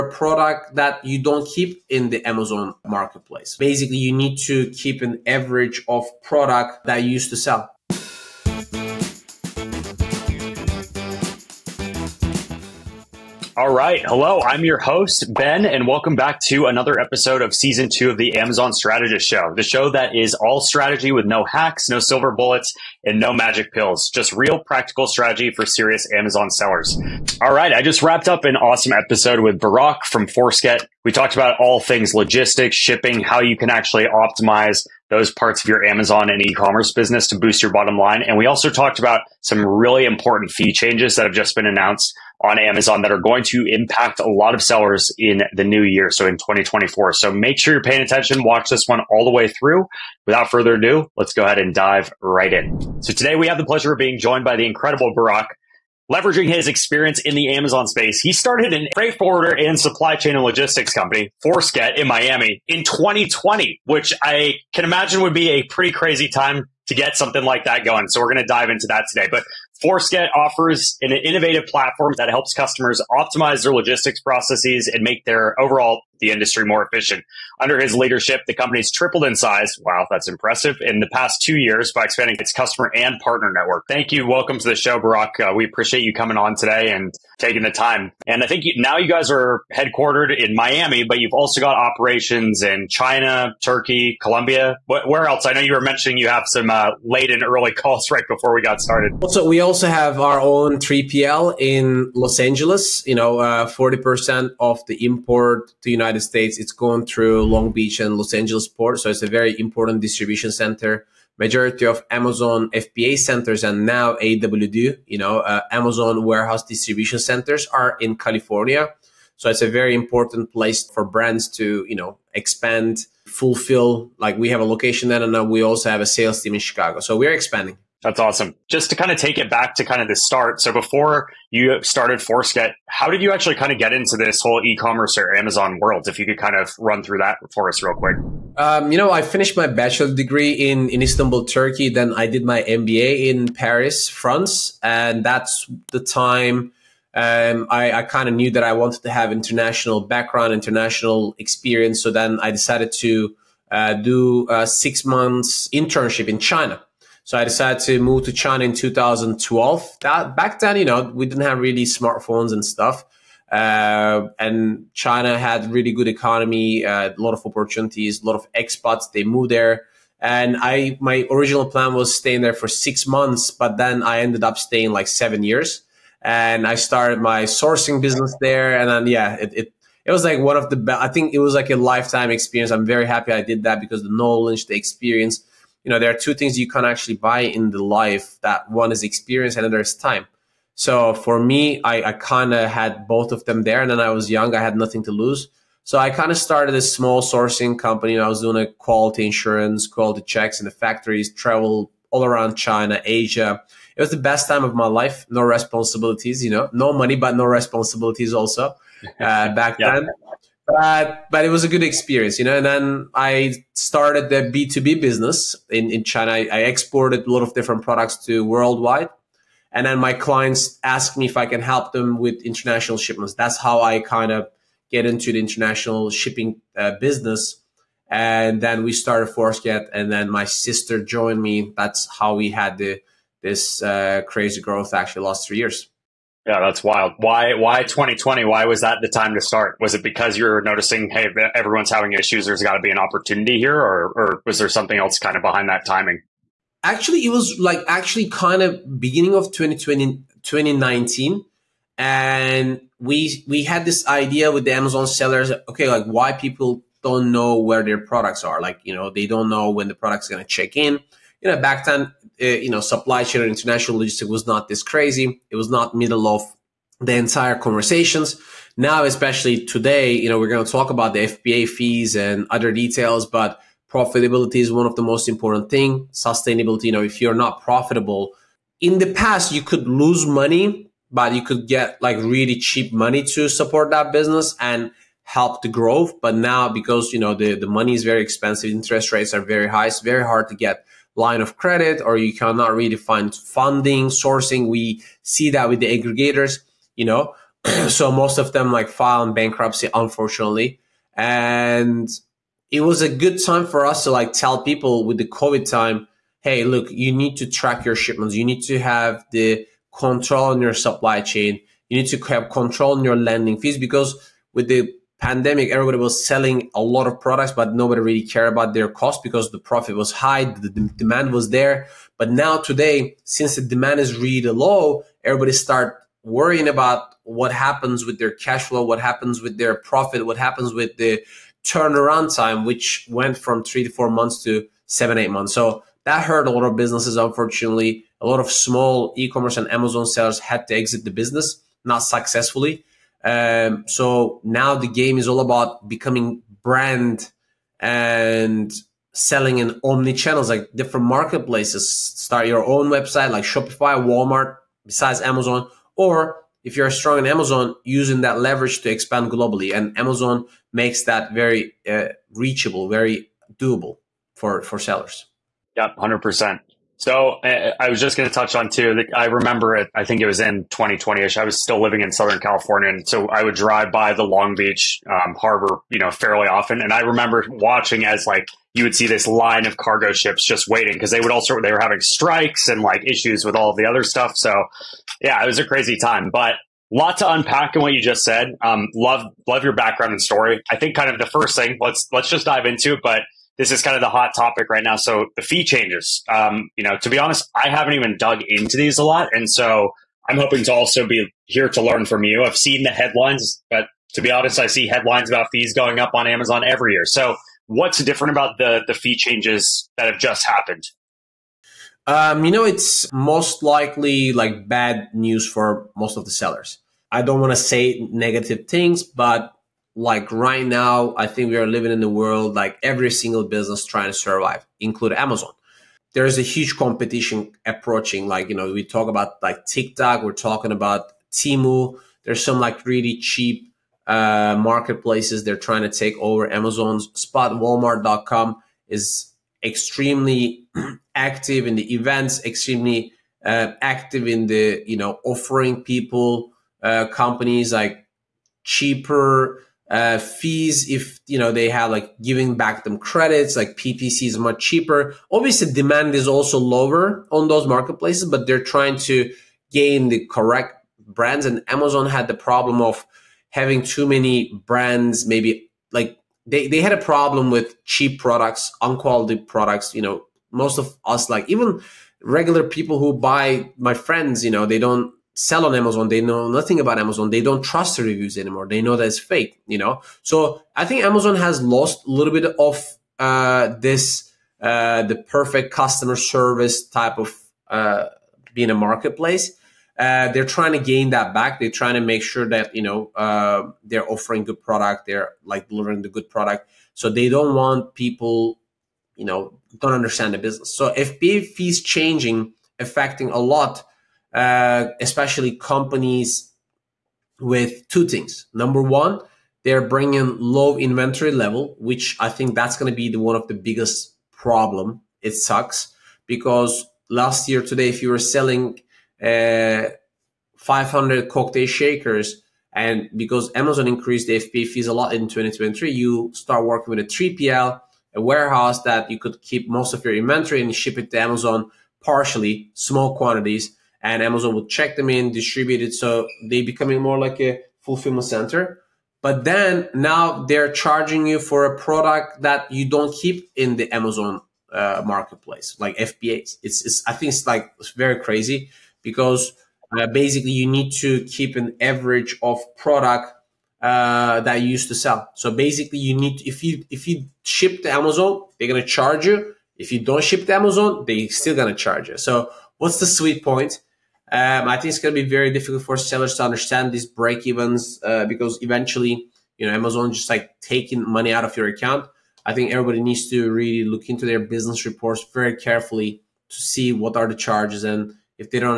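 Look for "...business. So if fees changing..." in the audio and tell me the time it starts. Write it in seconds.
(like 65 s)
500 s.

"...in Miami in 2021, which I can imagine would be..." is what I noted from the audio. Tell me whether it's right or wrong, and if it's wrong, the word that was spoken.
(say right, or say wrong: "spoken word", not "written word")
wrong: "2020", not "2021".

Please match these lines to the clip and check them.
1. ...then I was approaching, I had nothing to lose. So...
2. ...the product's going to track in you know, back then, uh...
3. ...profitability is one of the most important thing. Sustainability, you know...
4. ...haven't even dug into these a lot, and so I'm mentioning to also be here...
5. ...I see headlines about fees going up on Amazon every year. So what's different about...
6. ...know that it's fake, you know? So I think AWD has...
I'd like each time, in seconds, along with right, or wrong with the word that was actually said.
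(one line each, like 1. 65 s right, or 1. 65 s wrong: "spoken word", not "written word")
1. 193 s wrong: "young", not "approaching"
2. 259 s wrong: "check", not "track"
3. 273 s right
4. 397 s wrong: "hoping", not "mentioning"
5. 404 s right
6. 478 s wrong: "Amazon", not "AWD".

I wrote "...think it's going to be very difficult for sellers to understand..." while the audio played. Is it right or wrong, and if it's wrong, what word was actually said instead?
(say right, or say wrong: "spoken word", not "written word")
right.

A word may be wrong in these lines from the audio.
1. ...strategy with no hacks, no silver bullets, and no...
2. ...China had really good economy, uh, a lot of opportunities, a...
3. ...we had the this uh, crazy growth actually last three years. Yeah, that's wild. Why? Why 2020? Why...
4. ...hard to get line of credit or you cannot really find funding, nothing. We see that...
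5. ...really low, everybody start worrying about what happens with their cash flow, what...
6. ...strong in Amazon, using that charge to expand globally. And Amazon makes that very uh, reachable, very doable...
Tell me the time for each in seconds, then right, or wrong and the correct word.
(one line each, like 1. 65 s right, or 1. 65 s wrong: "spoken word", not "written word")
1. 20 s right
2. 164 s right
3. 232 s right
4. 290 s wrong: "sourcing", not "nothing"
5. 324 s right
6. 356 s wrong: "leverage", not "charge".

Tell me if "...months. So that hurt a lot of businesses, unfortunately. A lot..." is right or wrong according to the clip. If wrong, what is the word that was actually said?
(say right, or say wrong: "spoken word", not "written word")
right.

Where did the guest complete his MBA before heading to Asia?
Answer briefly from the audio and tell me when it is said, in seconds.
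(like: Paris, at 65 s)
Paris, France, at 143 s.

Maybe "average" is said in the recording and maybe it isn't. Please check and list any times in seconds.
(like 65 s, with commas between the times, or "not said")
5 s, 551 s.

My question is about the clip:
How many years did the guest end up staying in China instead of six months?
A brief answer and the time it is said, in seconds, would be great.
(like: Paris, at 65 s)
7 years, at 175 s.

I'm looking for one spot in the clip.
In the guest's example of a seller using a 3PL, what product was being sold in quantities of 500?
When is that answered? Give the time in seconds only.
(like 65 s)
521 s.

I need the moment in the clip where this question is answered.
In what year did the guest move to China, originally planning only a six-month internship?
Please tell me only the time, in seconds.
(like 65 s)
158 s.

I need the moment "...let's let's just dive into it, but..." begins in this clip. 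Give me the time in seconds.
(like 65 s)
391 s.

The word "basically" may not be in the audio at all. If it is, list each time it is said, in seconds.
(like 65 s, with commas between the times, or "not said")
3 s, 550 s, 555 s.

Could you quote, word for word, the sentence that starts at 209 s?
then but but it was a good experience, you know.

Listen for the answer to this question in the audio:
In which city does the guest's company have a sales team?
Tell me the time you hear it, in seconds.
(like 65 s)
126 s.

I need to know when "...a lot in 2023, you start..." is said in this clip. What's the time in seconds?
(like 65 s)
524 s.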